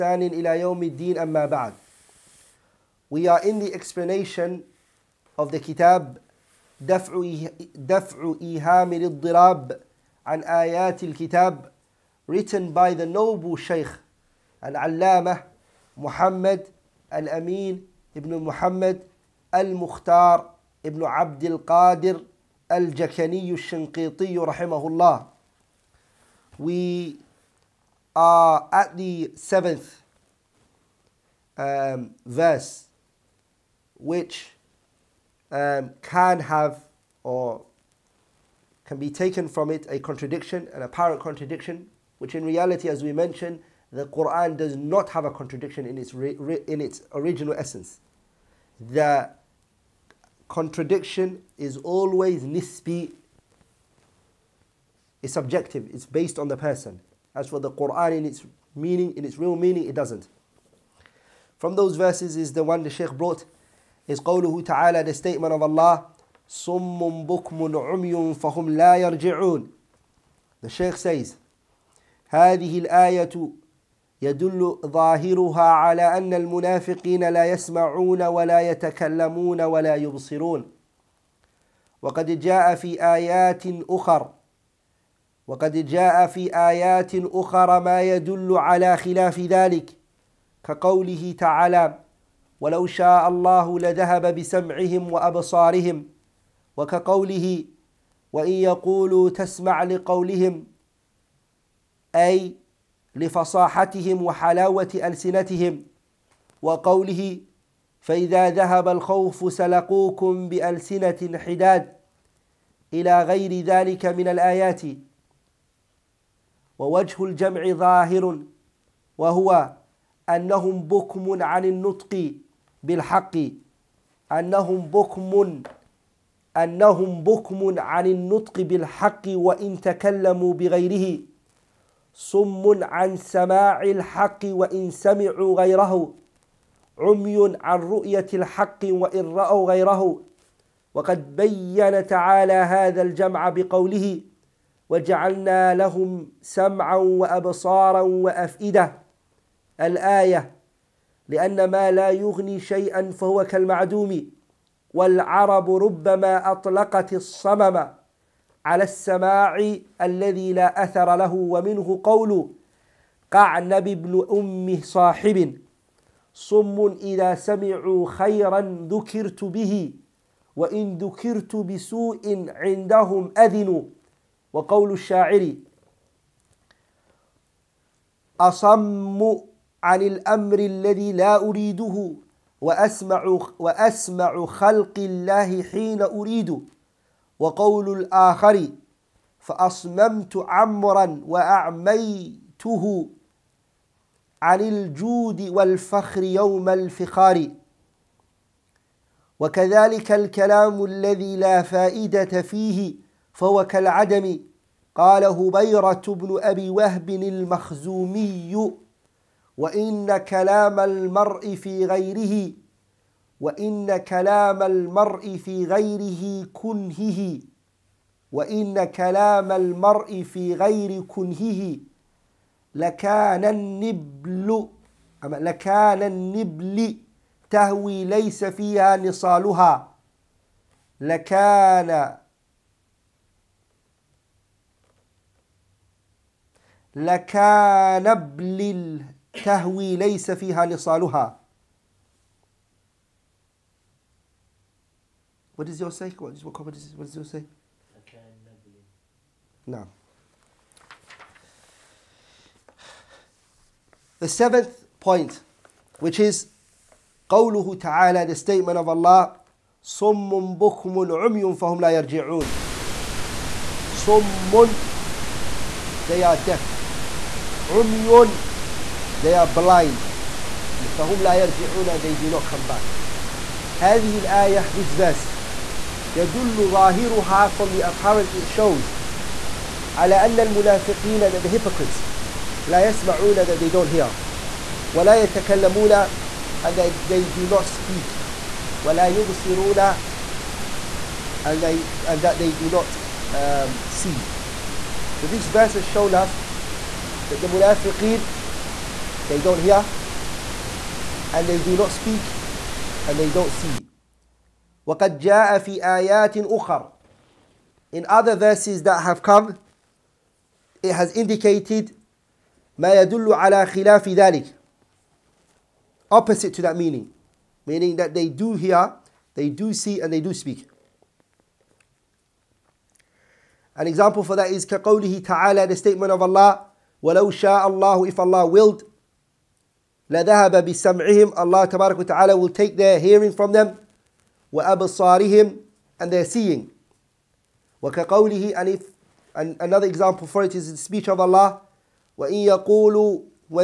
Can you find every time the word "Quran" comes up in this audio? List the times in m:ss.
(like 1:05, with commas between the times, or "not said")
0:44, 0:57.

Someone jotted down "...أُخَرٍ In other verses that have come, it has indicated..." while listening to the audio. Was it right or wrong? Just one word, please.
right.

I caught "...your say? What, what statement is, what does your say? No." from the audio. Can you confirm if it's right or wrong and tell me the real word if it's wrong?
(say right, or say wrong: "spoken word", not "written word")
wrong: "comment", not "statement".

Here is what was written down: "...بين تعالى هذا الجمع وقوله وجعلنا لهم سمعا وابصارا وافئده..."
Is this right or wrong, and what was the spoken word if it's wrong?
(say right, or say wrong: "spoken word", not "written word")
wrong: "بقوله", not "وقوله".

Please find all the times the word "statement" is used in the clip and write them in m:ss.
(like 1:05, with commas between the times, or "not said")
1:05, 4:18, 5:25.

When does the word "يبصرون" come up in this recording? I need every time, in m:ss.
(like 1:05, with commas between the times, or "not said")
1:19, 4:49.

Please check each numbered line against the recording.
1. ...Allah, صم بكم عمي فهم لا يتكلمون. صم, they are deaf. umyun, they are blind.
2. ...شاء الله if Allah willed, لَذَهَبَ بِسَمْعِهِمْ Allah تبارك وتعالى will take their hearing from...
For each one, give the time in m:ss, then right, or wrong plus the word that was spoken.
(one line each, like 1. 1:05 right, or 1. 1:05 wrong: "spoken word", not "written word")
1. 4:18 wrong: "يرجعون", not "يتكلمون"
2. 5:27 right.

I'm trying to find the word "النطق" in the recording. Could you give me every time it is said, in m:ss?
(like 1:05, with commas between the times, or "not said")
2:01, 2:08.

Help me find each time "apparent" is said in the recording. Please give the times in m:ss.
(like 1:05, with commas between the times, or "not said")
0:40, 4:37.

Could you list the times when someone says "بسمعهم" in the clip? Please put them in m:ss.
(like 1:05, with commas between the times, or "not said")
1:34, 5:30.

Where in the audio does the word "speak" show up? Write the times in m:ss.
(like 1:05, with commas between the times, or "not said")
4:47, 5:01, 5:20.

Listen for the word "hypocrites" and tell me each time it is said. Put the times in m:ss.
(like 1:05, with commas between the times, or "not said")
4:41.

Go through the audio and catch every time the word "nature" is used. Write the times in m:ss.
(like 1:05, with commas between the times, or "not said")
not said.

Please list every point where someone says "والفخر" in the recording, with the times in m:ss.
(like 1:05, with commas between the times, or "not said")
3:15.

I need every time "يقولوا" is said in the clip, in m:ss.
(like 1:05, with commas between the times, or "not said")
1:38, 5:42.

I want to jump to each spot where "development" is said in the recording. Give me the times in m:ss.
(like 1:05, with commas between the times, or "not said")
not said.